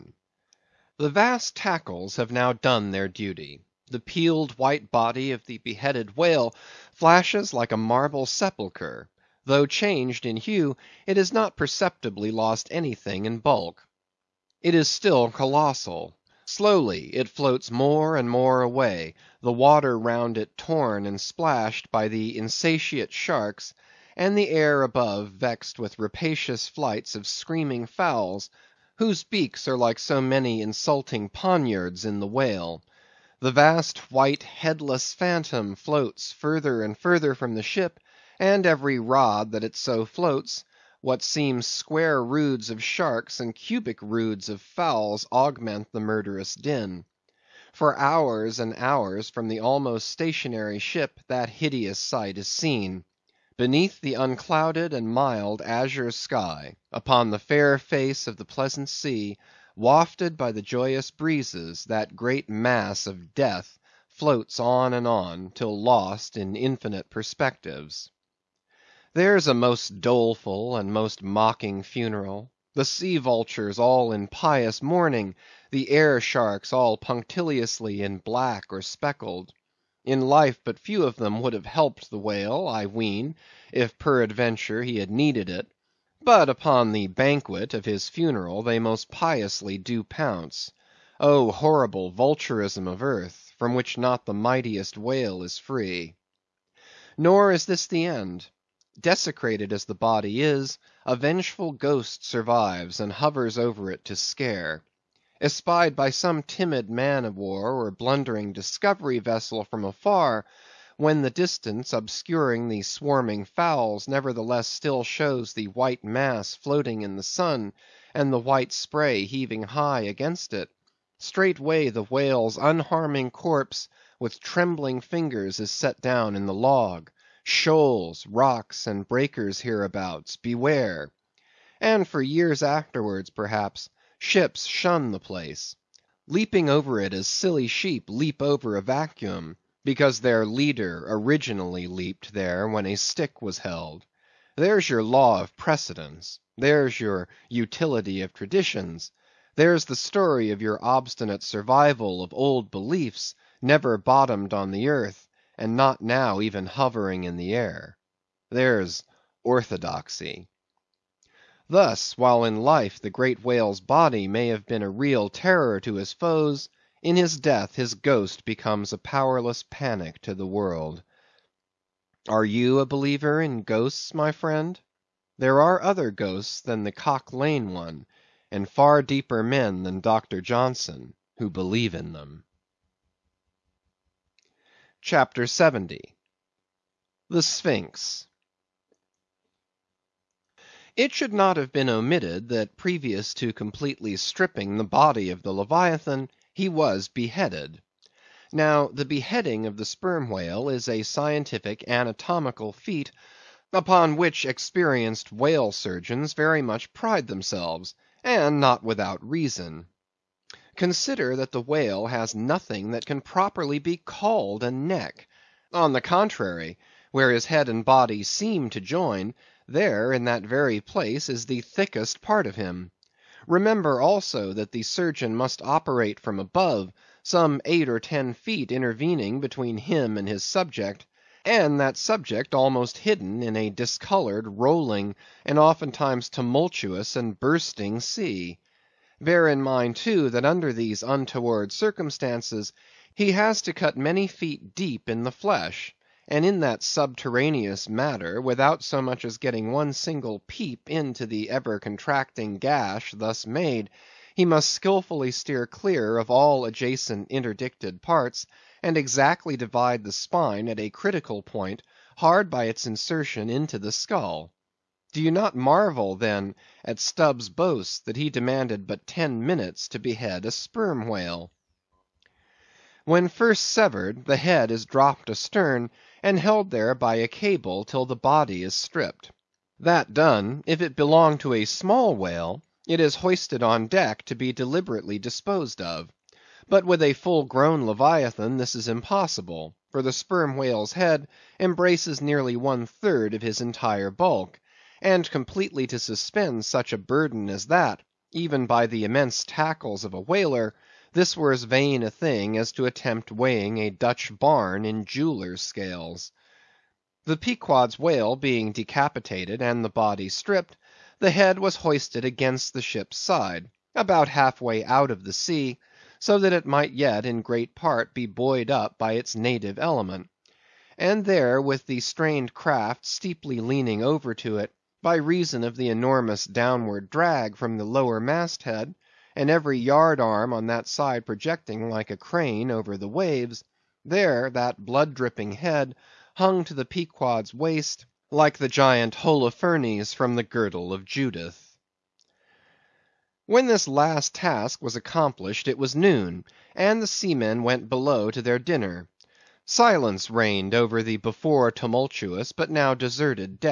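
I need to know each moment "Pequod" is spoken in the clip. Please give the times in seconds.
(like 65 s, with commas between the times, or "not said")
307 s, 336 s.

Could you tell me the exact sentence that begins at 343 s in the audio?
When this last task was accomplished it was noon, and the seamen went below to their dinner.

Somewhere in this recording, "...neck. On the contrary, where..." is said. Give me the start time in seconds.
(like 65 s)
214 s.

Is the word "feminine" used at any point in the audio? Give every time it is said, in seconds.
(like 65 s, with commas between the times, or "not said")
not said.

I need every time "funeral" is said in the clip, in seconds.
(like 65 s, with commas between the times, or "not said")
71 s, 88 s.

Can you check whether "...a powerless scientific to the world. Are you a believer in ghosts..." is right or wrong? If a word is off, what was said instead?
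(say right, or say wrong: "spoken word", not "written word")
wrong: "panic", not "scientific".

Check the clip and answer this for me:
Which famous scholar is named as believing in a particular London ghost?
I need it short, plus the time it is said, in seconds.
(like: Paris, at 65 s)
Doctor Johnson, at 180 s.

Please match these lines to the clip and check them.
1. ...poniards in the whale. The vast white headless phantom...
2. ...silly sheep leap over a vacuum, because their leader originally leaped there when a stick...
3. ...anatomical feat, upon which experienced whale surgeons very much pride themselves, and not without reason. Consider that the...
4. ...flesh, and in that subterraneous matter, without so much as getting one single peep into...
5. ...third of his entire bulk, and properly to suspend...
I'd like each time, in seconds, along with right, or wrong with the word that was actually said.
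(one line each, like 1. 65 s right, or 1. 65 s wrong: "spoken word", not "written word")
1. 31 s right
2. 137 s right
3. 201 s right
4. 245 s right
5. 292 s wrong: "completely", not "properly".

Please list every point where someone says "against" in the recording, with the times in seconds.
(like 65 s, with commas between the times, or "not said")
120 s, 312 s.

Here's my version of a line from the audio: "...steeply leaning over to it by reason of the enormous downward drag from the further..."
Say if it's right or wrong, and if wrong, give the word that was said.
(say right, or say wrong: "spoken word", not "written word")
wrong: "lower", not "further".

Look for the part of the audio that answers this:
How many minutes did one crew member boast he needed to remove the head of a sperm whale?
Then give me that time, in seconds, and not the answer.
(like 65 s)
269 s.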